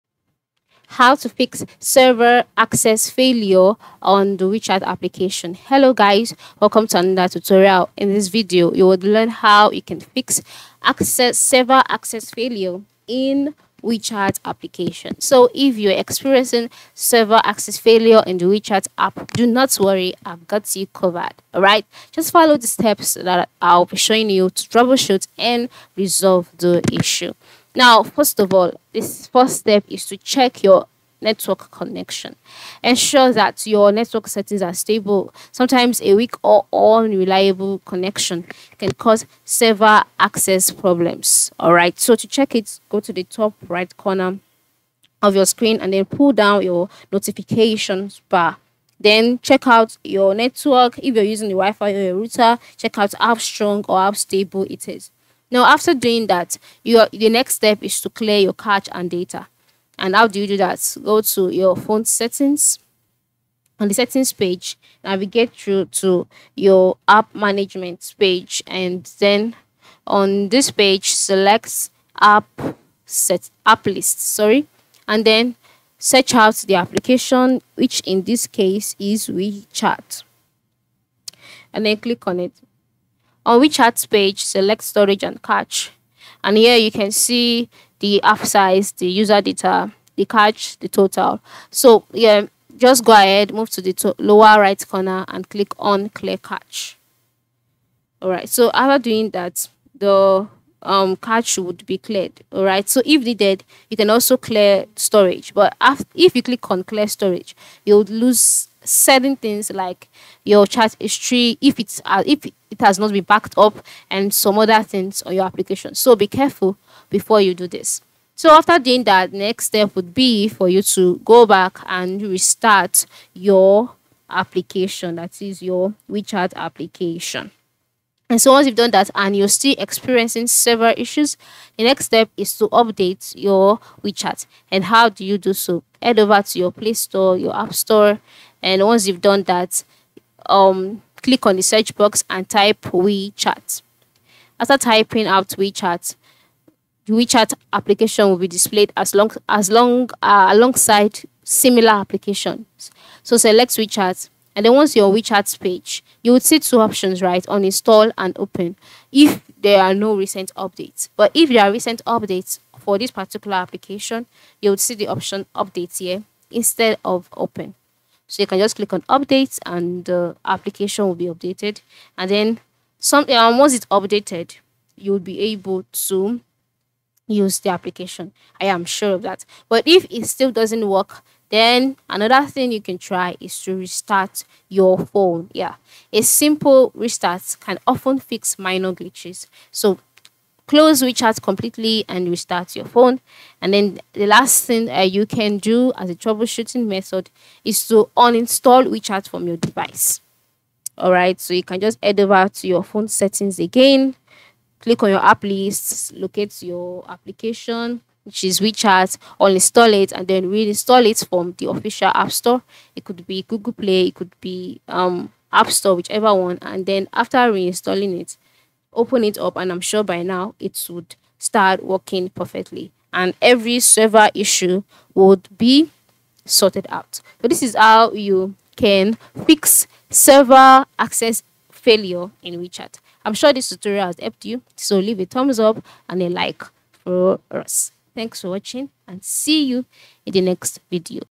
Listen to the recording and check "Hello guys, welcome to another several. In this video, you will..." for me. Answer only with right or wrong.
wrong.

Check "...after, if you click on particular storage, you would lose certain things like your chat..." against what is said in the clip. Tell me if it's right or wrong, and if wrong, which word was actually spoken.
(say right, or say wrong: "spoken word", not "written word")
wrong: "clear", not "particular".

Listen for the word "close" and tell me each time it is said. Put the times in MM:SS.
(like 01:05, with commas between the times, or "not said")
03:10.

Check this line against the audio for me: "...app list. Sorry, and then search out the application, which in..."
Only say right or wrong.
right.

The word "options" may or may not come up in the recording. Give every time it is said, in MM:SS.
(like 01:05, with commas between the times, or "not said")
02:36, 02:45.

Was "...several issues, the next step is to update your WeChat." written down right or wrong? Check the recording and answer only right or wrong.
right.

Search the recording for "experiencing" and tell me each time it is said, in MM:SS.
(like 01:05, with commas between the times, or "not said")
00:15, 02:09.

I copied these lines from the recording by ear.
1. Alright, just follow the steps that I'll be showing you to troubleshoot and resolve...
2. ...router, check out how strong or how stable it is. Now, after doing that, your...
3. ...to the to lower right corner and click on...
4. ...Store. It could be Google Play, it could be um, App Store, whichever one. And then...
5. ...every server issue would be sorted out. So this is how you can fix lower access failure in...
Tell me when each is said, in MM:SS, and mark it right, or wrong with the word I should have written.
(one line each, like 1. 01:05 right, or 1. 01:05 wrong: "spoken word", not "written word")
1. 00:21 right
2. 00:52 right
3. 01:33 right
4. 03:32 right
5. 03:43 wrong: "server", not "lower".